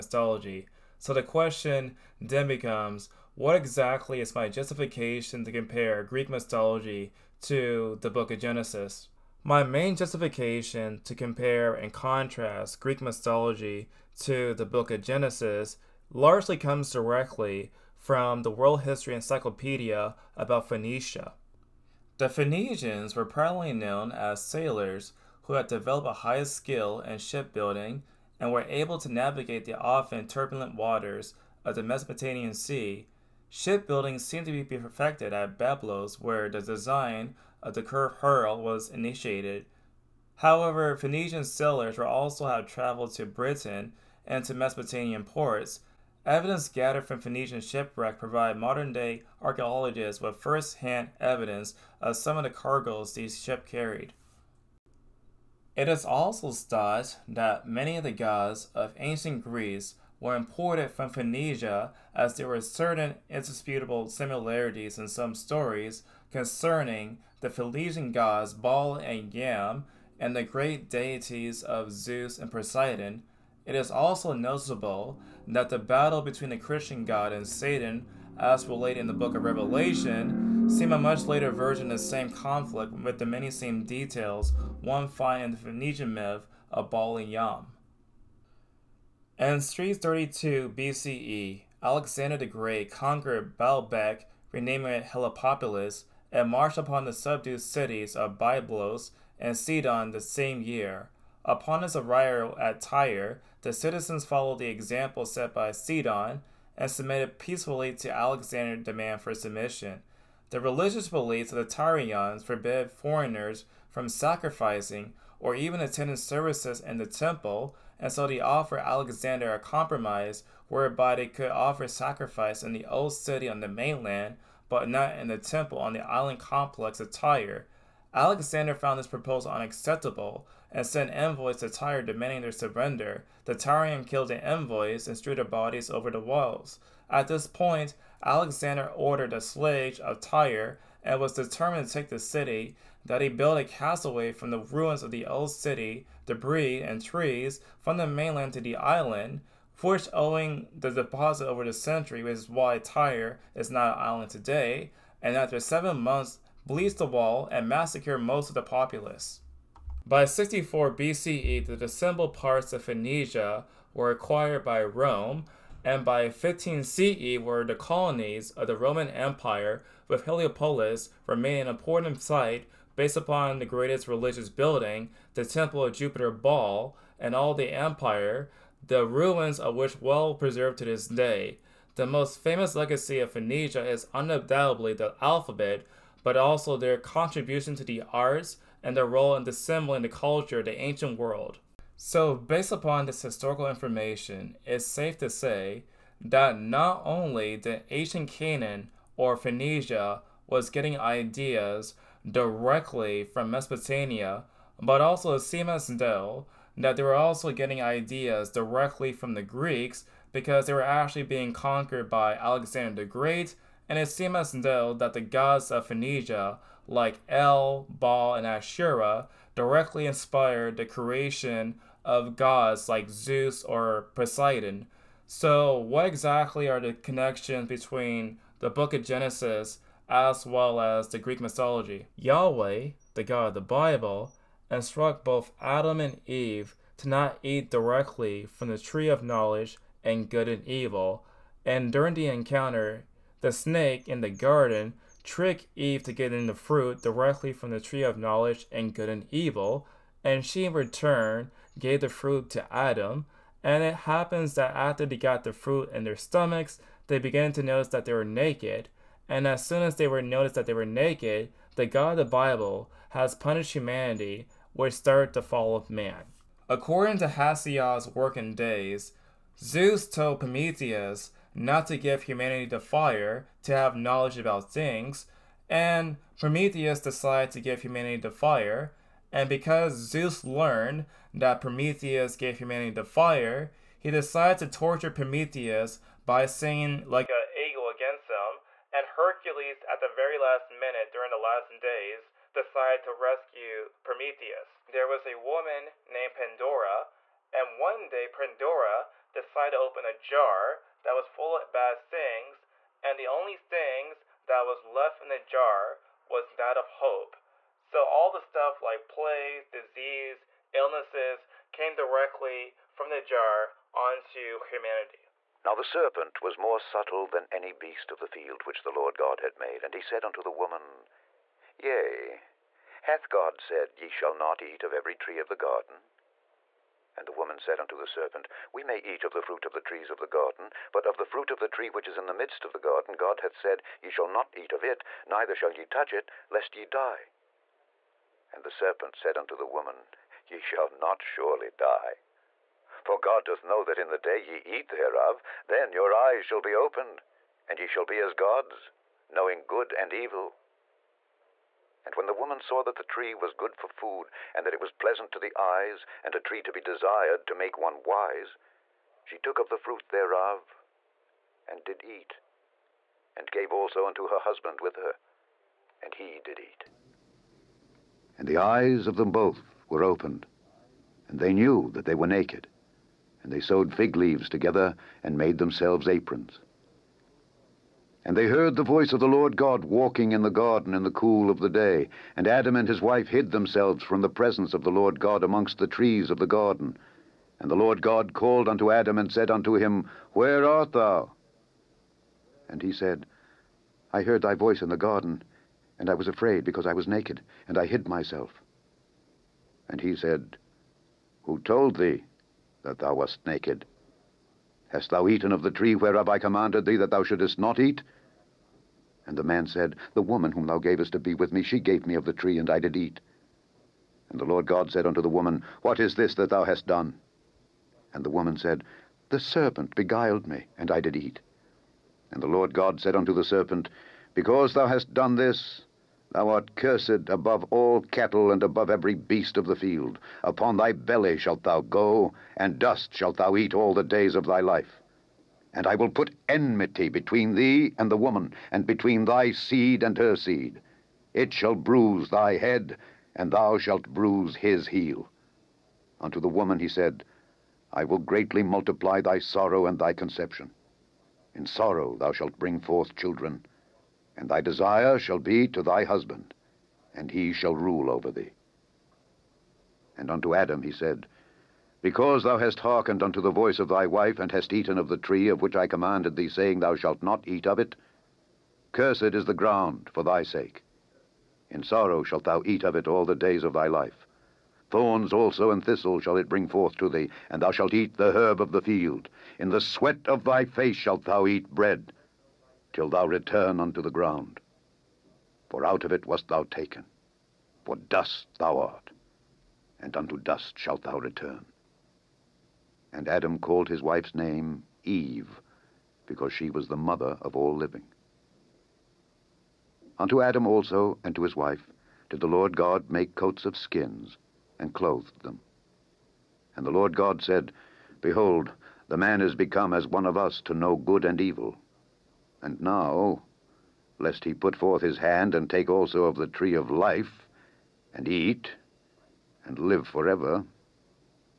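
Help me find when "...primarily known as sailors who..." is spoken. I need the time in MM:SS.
00:23.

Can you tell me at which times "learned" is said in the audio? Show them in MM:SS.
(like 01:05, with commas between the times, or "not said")
04:40.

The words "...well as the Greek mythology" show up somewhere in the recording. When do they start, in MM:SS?
03:50.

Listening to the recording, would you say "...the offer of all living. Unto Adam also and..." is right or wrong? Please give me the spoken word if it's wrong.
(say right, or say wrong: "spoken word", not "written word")
wrong: "mother", not "offer".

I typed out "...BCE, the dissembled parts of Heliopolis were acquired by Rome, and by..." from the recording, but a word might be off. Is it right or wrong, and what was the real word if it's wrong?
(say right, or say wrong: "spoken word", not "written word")
wrong: "Phoenicia", not "Heliopolis".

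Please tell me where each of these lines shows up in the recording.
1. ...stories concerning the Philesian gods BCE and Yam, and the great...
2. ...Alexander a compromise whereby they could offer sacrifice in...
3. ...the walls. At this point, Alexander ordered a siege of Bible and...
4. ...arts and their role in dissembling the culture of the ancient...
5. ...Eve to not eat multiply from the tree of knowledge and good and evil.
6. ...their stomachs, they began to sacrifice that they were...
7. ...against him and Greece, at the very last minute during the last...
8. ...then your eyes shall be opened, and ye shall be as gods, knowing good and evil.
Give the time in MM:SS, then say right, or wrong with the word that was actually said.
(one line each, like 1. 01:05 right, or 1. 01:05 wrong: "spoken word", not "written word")
1. 01:05 wrong: "Baal", not "BCE"
2. 01:58 right
3. 02:16 wrong: "Tyre", not "Bible"
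4. 03:08 right
5. 03:56 wrong: "directly", not "multiply"
6. 04:16 wrong: "notice", not "sacrifice"
7. 04:47 wrong: "Hercules", not "Greece"
8. 05:45 right.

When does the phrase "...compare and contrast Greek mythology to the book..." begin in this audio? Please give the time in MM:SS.
00:11.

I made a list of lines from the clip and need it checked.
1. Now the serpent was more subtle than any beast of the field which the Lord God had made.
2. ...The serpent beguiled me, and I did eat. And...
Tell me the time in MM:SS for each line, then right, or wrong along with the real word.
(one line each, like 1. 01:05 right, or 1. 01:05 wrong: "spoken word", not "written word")
1. 05:15 right
2. 06:59 right.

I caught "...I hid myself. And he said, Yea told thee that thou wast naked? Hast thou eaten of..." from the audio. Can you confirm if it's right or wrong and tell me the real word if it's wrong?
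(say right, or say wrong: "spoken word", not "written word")
wrong: "Who", not "Yea".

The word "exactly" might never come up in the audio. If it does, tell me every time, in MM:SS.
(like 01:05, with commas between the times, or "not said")
00:03, 03:46.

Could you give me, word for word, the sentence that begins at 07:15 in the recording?
And I will put enmity between thee and the woman, and between thy seed and her seed.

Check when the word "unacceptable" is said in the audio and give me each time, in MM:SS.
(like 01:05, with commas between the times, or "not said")
02:09.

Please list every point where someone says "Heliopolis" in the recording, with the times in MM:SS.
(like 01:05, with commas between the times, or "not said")
01:35, 02:50.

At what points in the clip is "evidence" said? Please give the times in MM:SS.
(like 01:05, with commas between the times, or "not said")
00:46, 00:51.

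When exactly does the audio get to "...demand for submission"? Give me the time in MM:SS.
01:48.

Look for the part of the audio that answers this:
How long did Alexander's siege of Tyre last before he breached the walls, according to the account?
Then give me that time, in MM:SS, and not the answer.
02:35.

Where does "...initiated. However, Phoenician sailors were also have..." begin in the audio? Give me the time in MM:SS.
00:38.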